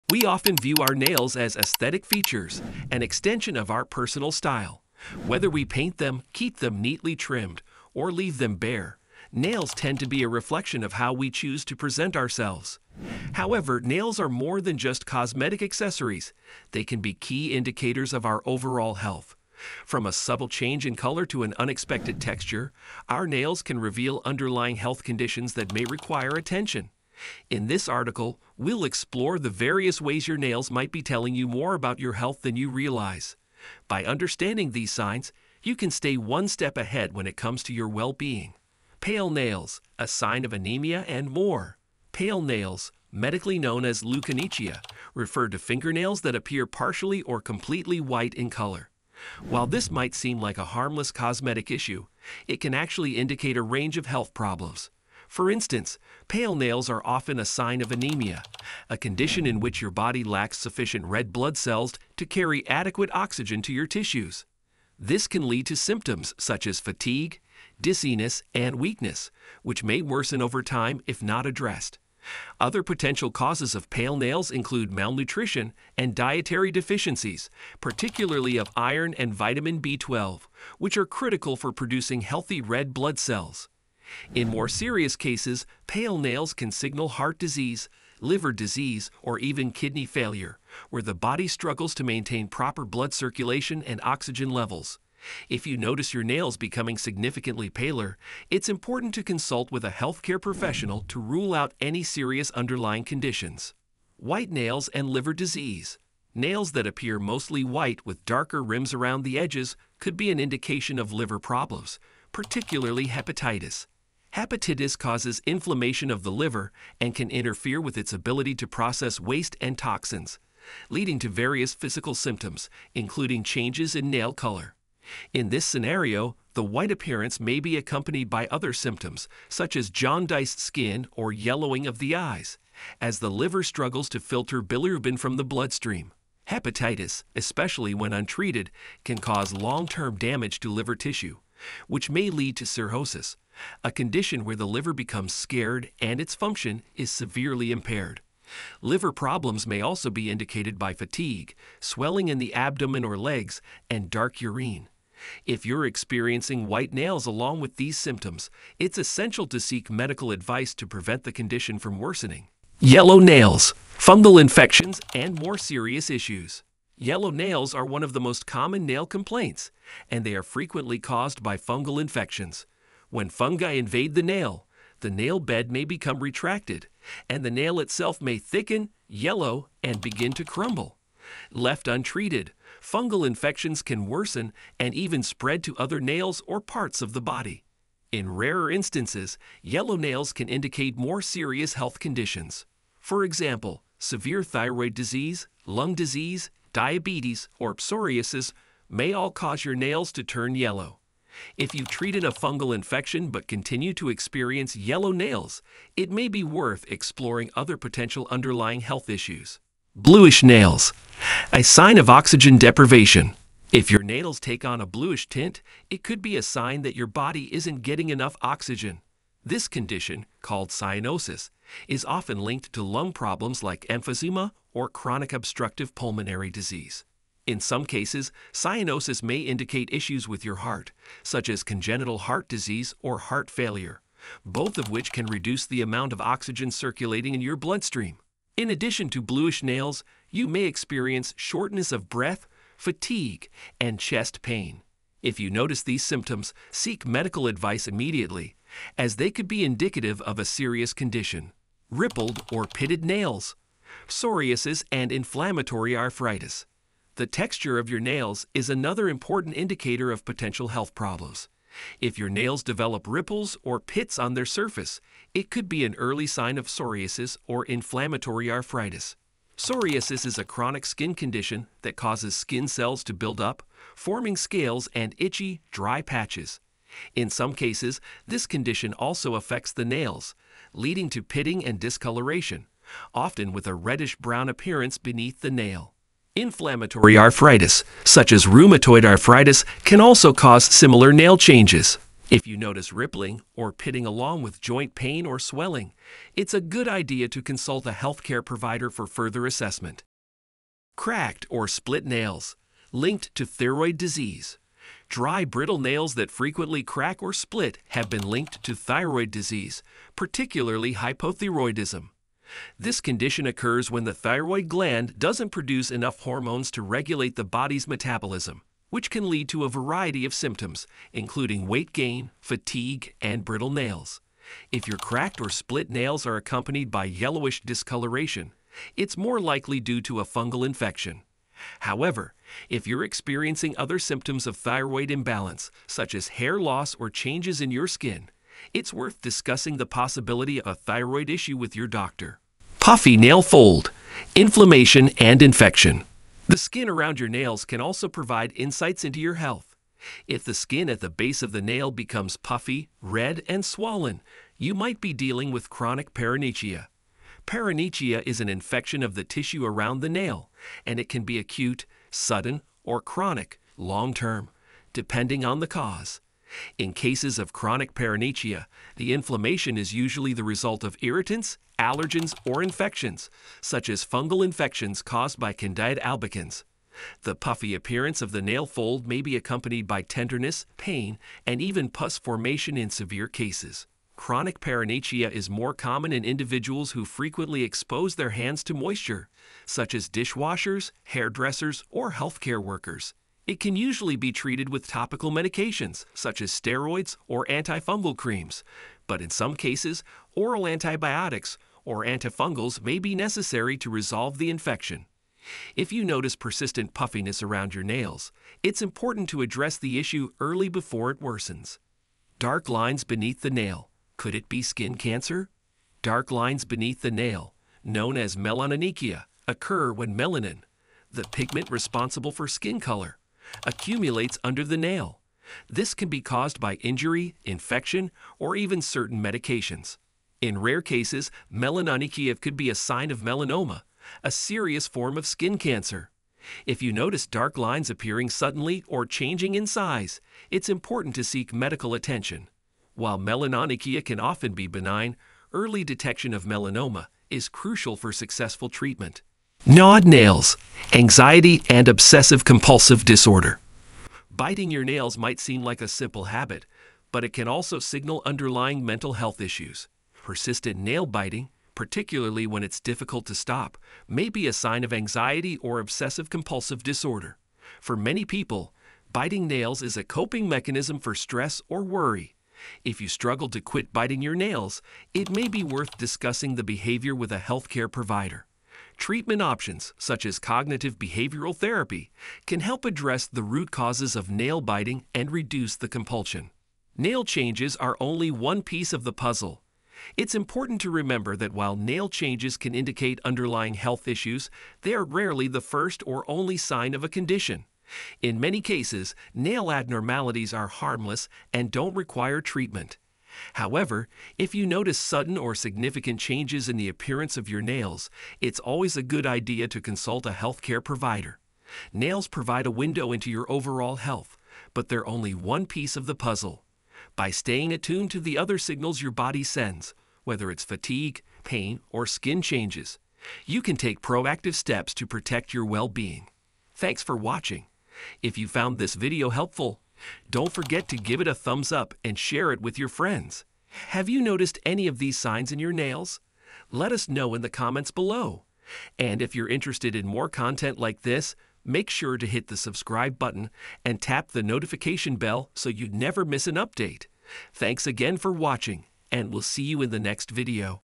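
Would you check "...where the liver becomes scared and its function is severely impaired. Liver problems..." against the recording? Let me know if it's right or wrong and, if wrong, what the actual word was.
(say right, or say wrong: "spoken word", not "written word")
right.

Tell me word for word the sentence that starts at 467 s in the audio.
For many people, biting nails is a coping mechanism for stress or worry.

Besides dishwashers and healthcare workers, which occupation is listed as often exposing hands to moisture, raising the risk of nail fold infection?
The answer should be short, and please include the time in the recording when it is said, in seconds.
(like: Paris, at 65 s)
hairdressers, at 391 s.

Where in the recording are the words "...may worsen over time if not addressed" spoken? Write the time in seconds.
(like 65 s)
69 s.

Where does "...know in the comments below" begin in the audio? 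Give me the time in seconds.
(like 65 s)
537 s.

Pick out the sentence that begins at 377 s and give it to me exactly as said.
The puffy appearance of the nail fold may be accompanied by tenderness, pain, and even pus formation in severe cases.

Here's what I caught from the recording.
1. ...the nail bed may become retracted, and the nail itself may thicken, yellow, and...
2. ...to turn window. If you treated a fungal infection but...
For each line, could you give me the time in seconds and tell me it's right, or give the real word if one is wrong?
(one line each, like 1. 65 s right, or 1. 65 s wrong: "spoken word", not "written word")
1. 175 s right
2. 200 s wrong: "yellow", not "window".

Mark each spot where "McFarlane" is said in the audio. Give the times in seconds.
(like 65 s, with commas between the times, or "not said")
not said.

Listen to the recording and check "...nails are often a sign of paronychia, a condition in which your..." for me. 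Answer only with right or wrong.
wrong.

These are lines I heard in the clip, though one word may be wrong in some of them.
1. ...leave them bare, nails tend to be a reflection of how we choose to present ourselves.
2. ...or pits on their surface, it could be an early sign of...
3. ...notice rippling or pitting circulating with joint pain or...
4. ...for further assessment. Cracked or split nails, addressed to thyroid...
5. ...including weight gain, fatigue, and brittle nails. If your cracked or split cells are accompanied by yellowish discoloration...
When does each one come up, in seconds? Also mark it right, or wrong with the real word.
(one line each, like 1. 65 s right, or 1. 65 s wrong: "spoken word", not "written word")
1. 8 s right
2. 263 s right
3. 292 s wrong: "along", not "circulating"
4. 298 s wrong: "linked", not "addressed"
5. 321 s wrong: "nails", not "cells".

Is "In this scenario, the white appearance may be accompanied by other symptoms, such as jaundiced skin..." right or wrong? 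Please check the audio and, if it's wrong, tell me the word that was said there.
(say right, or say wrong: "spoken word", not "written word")
right.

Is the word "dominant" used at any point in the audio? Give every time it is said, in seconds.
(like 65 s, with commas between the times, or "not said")
not said.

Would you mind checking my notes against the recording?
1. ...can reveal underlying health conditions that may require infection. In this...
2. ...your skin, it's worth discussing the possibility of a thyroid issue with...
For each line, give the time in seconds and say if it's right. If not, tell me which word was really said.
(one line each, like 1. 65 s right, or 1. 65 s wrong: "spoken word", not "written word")
1. 23 s wrong: "attention", not "infection"
2. 337 s right.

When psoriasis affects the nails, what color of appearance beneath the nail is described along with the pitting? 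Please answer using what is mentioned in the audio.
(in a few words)
reddish-brown.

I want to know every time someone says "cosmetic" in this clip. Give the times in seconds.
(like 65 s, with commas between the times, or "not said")
15 s, 51 s.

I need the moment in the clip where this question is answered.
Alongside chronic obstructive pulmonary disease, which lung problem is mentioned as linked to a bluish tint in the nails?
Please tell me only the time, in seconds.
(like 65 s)
223 s.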